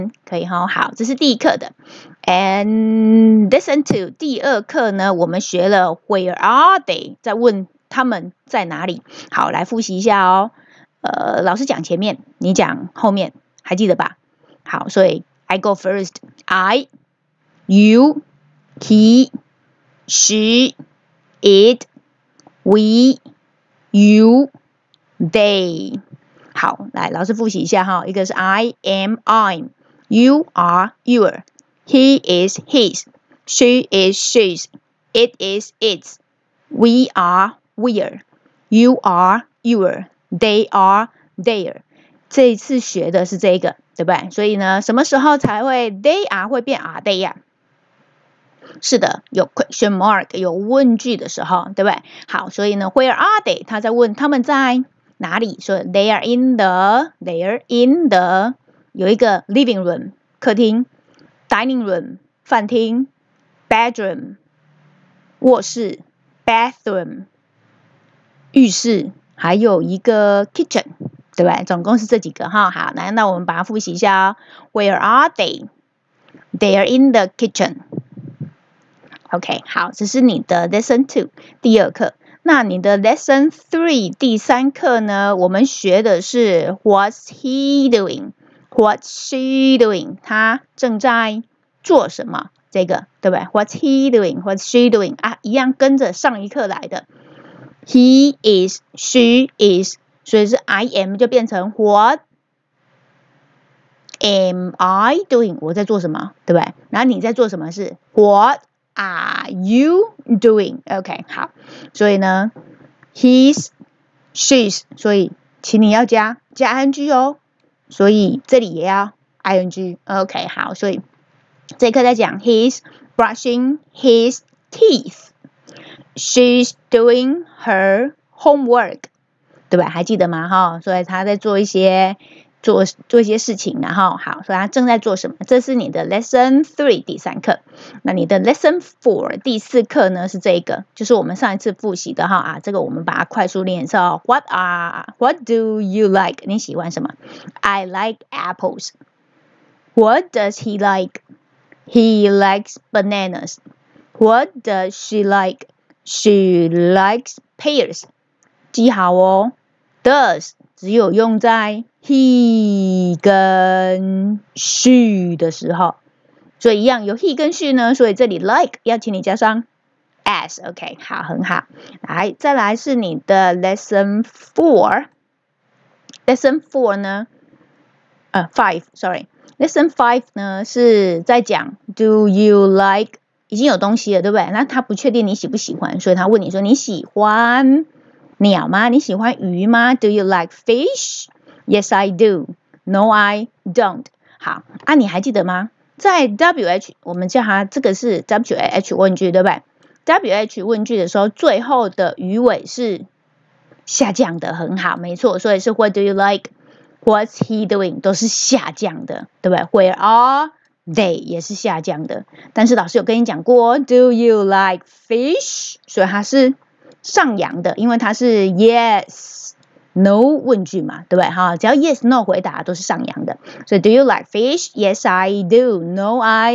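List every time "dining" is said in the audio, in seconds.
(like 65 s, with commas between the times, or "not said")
61 s.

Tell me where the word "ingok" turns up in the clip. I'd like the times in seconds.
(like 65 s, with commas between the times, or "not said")
119 s.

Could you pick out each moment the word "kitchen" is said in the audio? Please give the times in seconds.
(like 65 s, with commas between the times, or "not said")
70 s, 77 s.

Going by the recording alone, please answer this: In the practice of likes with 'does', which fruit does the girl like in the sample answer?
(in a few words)
pears.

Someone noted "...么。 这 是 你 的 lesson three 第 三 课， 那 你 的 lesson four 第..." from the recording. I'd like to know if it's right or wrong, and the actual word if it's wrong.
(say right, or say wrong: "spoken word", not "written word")
right.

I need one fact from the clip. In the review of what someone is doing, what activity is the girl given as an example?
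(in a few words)
doing her homework.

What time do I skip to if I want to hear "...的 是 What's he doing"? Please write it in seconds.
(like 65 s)
86 s.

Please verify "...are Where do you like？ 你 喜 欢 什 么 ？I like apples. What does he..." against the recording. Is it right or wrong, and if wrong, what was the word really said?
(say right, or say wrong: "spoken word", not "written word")
wrong: "What", not "Where".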